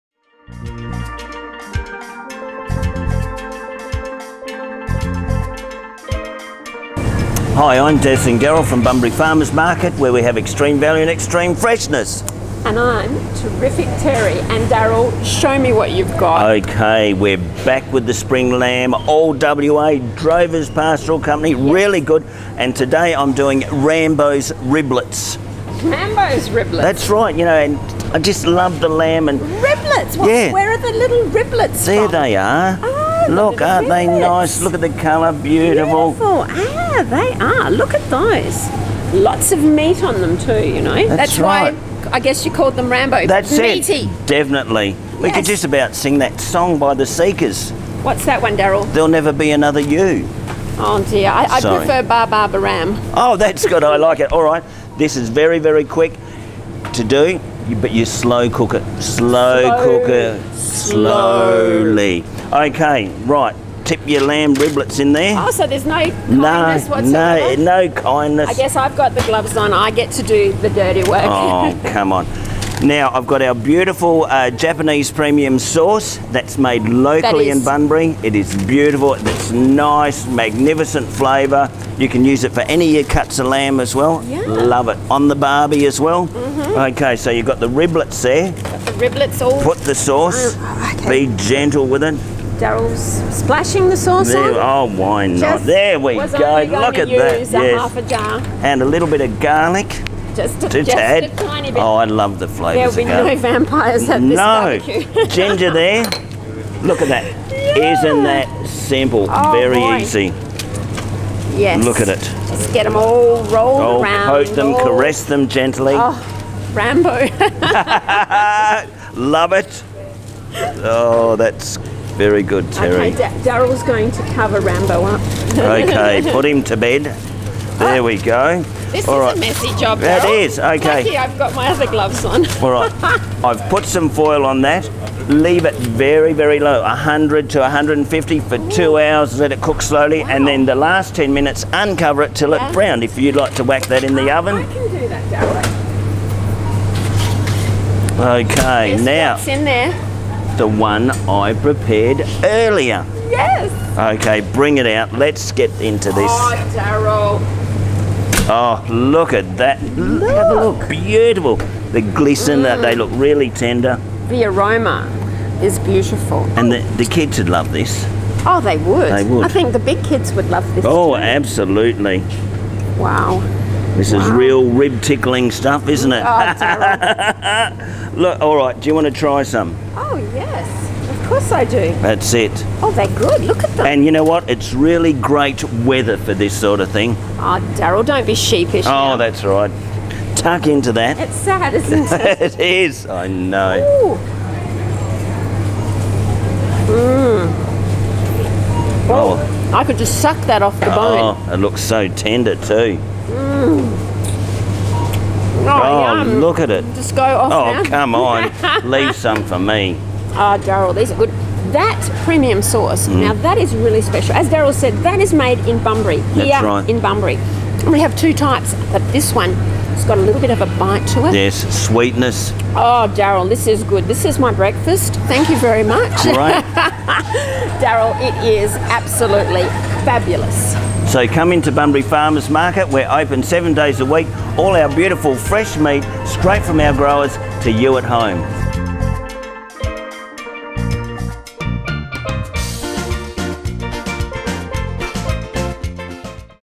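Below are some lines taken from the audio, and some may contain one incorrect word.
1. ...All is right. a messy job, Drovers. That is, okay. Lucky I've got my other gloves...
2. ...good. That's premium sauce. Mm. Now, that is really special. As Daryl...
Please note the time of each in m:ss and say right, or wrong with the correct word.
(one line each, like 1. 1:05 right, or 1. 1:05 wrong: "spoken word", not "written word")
1. 2:09 wrong: "Daryl", not "Drovers"
2. 3:31 right.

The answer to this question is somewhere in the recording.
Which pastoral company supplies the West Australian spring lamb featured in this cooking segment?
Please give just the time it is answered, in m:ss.
0:20.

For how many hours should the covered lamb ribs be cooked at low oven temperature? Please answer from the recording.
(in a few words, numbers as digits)
2 hours.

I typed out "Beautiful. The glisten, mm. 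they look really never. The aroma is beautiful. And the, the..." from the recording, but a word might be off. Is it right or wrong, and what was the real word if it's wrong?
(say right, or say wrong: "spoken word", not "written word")
wrong: "tender", not "never".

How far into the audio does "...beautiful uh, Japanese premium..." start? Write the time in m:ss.
1:13.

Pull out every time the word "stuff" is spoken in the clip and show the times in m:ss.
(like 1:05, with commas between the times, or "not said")
2:55.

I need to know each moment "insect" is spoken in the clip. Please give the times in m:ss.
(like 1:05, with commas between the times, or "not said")
not said.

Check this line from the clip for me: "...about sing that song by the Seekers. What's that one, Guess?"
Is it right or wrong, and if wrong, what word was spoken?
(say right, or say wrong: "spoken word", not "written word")
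wrong: "Daryl", not "Guess".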